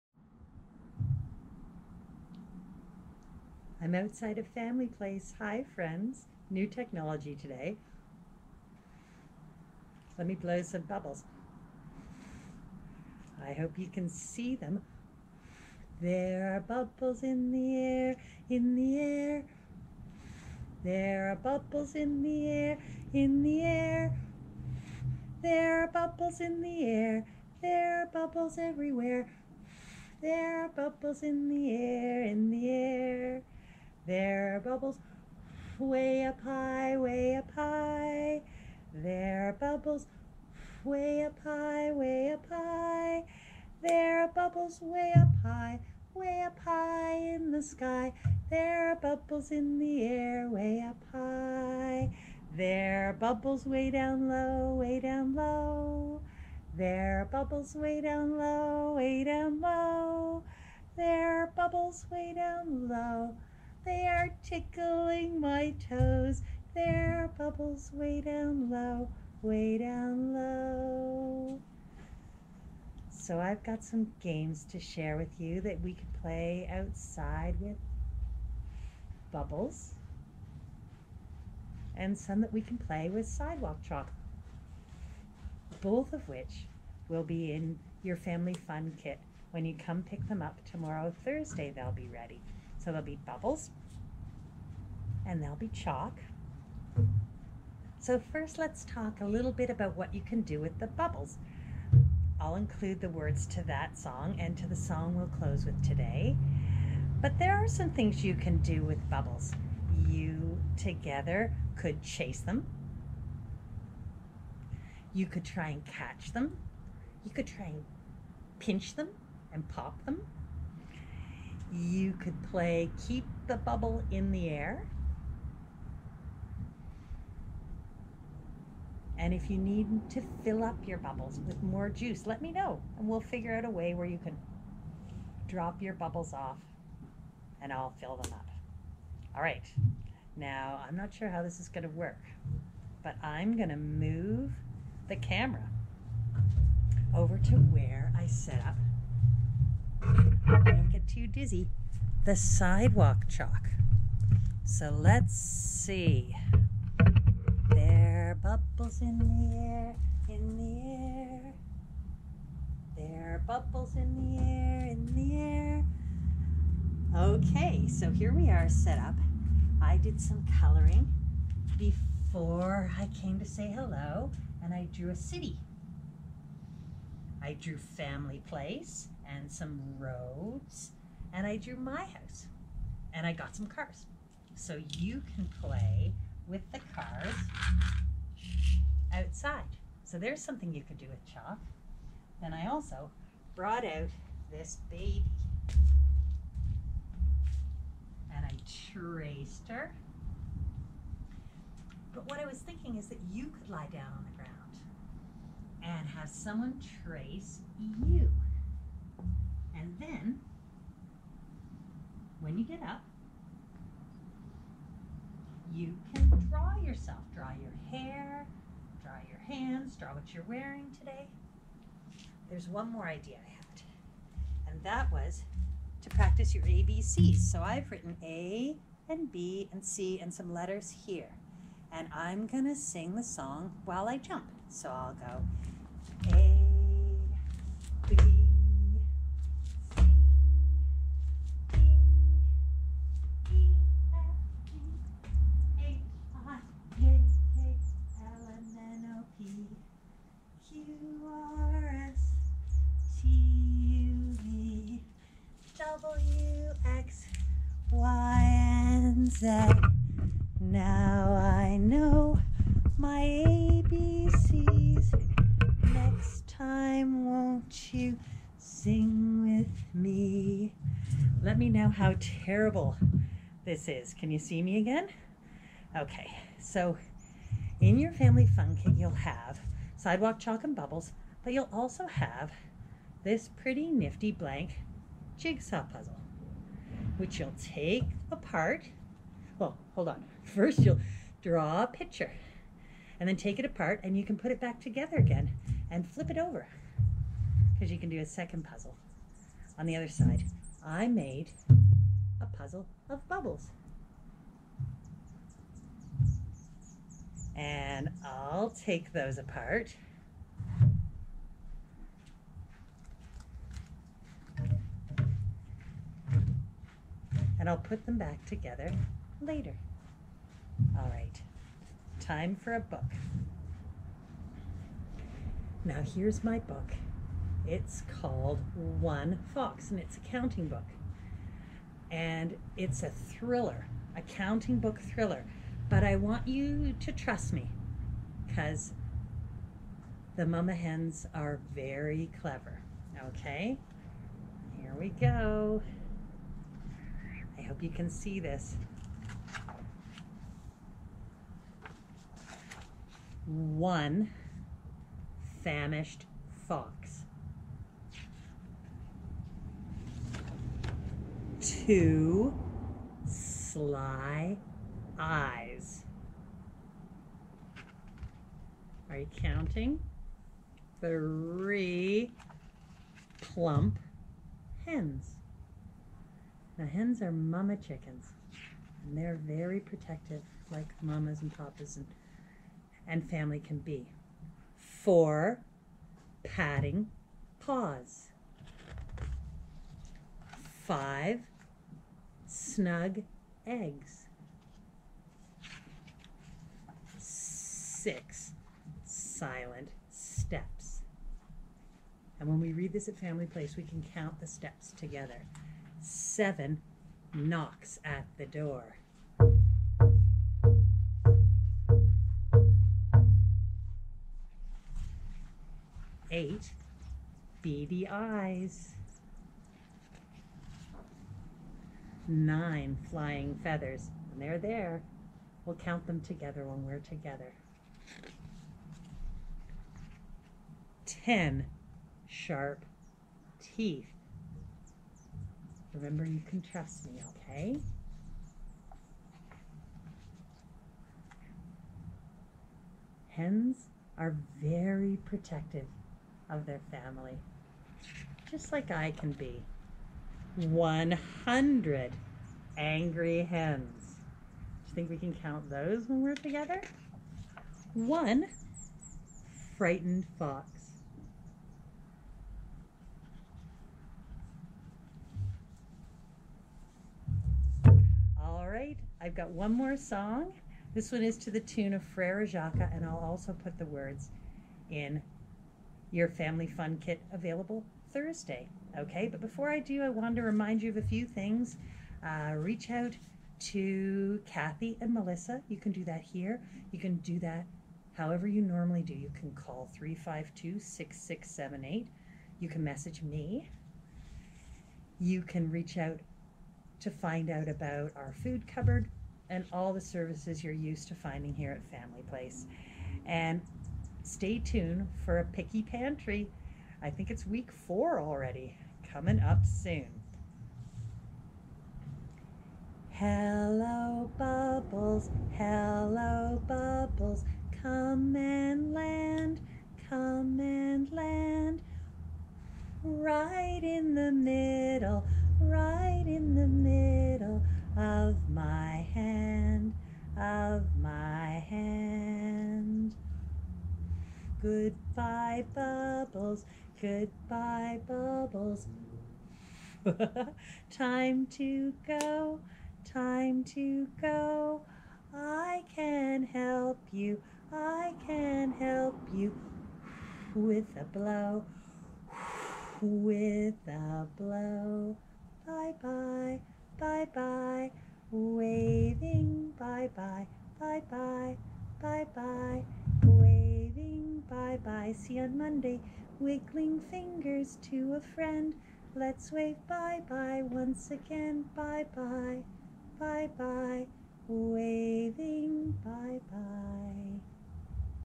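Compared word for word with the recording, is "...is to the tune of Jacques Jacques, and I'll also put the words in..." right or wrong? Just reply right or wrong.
wrong.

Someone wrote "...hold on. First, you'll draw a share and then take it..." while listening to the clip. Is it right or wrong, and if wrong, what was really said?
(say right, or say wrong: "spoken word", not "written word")
wrong: "picture", not "share".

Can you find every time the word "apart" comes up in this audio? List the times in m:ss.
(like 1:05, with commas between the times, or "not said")
4:48, 4:53, 5:09.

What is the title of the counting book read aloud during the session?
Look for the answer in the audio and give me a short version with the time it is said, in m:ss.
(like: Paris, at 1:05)
One Fox, at 5:28.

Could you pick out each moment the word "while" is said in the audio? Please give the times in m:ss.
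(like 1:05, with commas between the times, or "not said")
3:53.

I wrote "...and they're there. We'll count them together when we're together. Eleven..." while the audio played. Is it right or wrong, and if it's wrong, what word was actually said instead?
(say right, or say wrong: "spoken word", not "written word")
wrong: "Ten", not "Eleven".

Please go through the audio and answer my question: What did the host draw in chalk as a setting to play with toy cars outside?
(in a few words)
A city.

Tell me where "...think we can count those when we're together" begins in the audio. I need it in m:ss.
7:34.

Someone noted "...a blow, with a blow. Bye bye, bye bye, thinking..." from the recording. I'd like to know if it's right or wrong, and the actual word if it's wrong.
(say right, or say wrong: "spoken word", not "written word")
wrong: "waving", not "thinking".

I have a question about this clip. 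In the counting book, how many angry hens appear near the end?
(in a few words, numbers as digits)
100.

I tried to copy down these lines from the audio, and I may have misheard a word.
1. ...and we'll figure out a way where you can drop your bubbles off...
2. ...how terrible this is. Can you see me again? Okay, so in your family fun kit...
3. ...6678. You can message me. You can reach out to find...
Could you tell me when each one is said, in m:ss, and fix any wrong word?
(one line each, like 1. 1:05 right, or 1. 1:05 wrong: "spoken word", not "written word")
1. 2:12 right
2. 4:31 right
3. 8:10 right.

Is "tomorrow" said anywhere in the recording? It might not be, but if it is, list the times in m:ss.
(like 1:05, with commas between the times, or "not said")
1:30.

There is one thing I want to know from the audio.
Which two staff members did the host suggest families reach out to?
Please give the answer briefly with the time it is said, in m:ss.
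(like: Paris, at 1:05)
Kathy and Melissa, at 8:04.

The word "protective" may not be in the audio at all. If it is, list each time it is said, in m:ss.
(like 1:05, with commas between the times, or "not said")
6:19, 7:25.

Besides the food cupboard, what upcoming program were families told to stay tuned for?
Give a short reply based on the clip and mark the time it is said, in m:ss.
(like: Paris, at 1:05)
Picky pantry, at 8:25.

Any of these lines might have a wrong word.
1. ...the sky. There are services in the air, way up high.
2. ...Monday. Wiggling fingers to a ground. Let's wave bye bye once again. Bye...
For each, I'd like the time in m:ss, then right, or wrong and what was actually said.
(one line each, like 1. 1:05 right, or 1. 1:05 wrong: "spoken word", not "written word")
1. 0:47 wrong: "bubbles", not "services"
2. 9:25 wrong: "friend", not "ground".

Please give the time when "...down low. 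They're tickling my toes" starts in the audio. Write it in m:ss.
1:02.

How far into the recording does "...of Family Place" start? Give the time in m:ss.
0:04.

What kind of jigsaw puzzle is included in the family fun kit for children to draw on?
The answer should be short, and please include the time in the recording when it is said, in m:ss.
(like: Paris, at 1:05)
Blank jigsaw puzzle, at 4:44.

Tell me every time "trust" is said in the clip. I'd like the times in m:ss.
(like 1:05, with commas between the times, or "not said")
5:37, 7:16.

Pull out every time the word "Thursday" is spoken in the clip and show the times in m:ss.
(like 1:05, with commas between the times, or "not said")
1:31, 7:58.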